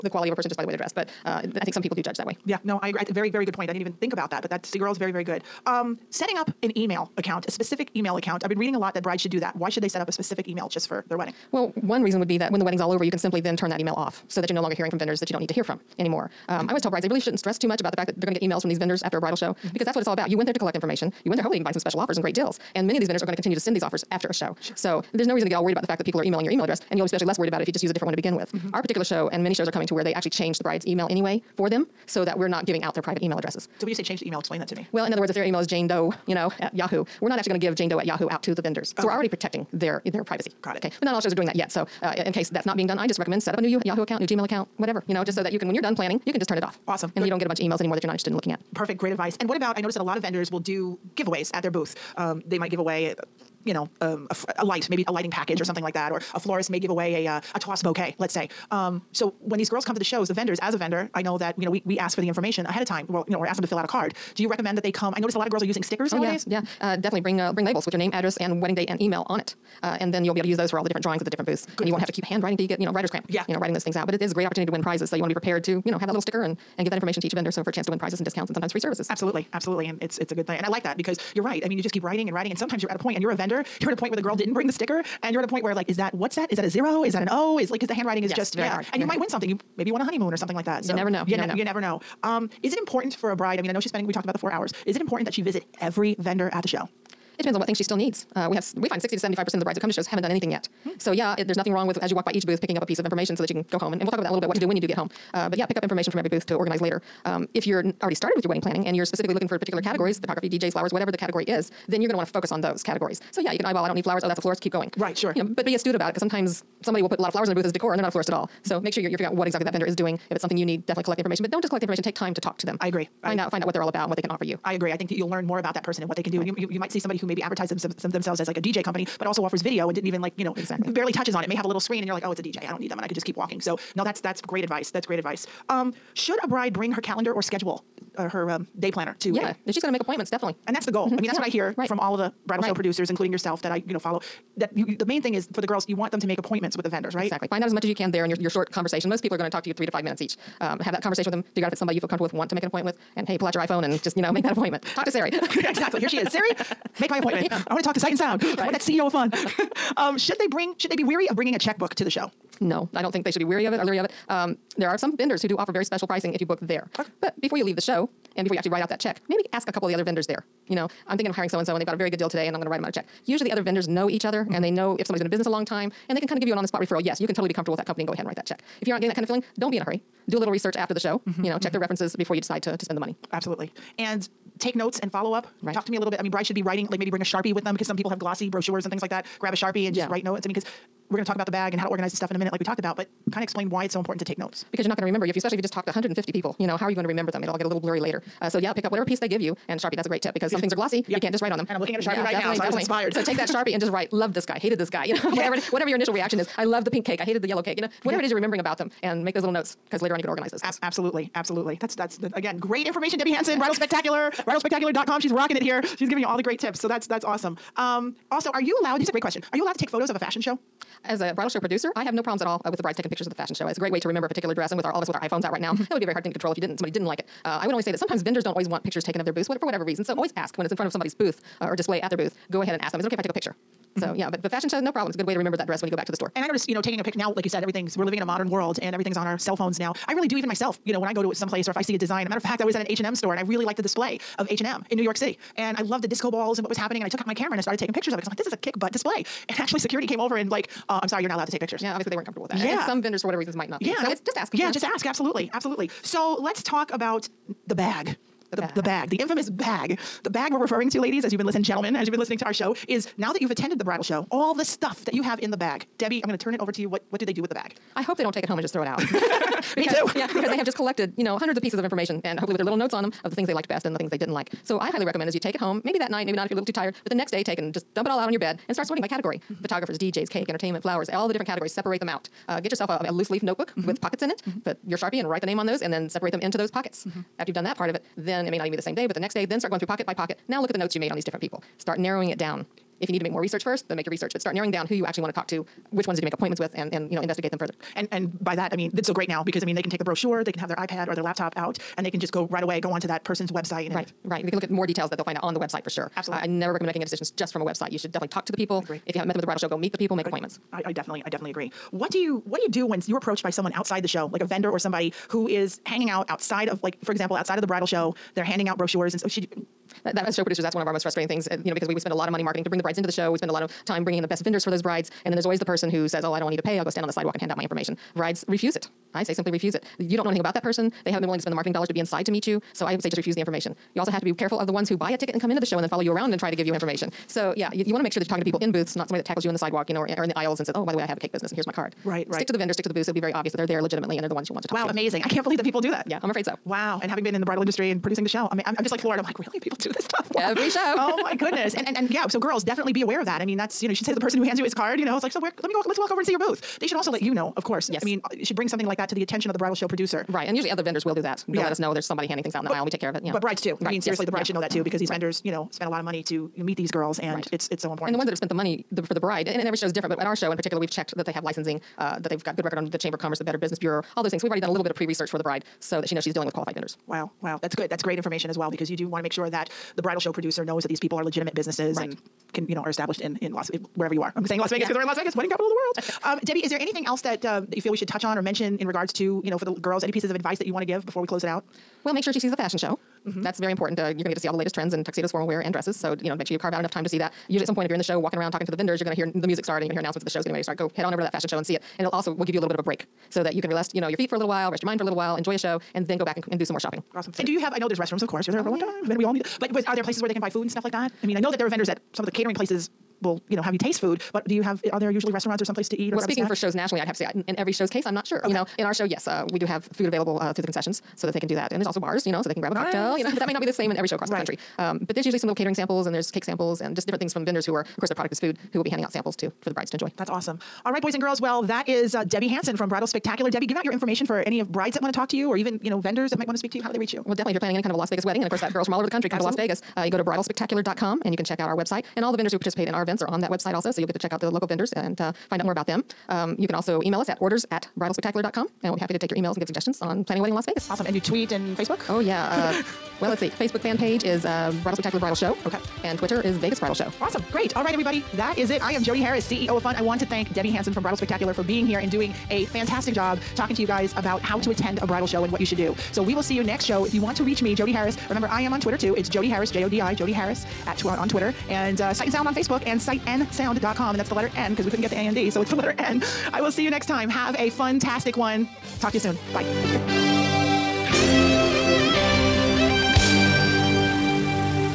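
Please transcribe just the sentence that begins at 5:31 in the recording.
They haven't been willing to spend the marketing dollars to be inside to meet you.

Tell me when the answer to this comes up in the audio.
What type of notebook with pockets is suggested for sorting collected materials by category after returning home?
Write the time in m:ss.
4:43.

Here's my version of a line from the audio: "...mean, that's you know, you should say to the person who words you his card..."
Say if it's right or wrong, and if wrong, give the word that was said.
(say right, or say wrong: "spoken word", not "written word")
wrong: "hands", not "words".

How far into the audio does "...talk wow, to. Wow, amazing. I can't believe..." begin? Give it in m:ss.
5:44.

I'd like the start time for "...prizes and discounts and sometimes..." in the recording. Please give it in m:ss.
1:17.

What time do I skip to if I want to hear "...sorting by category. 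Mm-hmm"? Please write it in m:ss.
4:38.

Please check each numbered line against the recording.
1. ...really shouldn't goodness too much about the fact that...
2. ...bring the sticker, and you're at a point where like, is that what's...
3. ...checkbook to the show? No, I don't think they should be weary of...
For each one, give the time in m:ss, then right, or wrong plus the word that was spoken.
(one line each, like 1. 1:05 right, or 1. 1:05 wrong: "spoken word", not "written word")
1. 0:17 wrong: "stress", not "goodness"
2. 1:24 right
3. 2:41 right.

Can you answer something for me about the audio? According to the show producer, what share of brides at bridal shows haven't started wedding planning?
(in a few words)
60 to 75 percent.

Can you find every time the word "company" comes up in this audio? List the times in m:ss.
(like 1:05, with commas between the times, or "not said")
2:08, 2:57.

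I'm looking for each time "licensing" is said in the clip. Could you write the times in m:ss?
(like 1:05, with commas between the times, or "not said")
6:11.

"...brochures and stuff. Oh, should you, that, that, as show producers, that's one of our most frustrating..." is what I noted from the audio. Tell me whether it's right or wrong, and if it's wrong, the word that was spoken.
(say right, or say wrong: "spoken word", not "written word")
right.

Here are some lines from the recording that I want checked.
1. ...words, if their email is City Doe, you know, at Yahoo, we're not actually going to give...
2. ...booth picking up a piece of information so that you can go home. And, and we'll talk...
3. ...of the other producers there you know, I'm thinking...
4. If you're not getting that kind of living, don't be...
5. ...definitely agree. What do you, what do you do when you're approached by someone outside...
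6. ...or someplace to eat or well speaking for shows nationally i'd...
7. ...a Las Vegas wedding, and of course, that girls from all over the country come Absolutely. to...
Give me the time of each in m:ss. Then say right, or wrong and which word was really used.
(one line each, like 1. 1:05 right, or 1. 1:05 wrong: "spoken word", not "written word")
1. 0:35 wrong: "Jane", not "City"
2. 1:42 right
3. 2:49 wrong: "vendors", not "producers"
4. 2:58 wrong: "feeling", not "living"
5. 5:11 right
6. 6:55 right
7. 7:17 right.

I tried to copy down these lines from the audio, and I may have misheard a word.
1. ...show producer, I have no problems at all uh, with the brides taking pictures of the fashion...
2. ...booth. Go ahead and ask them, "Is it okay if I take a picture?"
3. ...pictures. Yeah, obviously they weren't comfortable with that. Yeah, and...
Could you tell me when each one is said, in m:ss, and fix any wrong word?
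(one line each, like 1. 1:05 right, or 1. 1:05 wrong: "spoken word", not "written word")
1. 3:41 right
2. 3:52 right
3. 4:11 right.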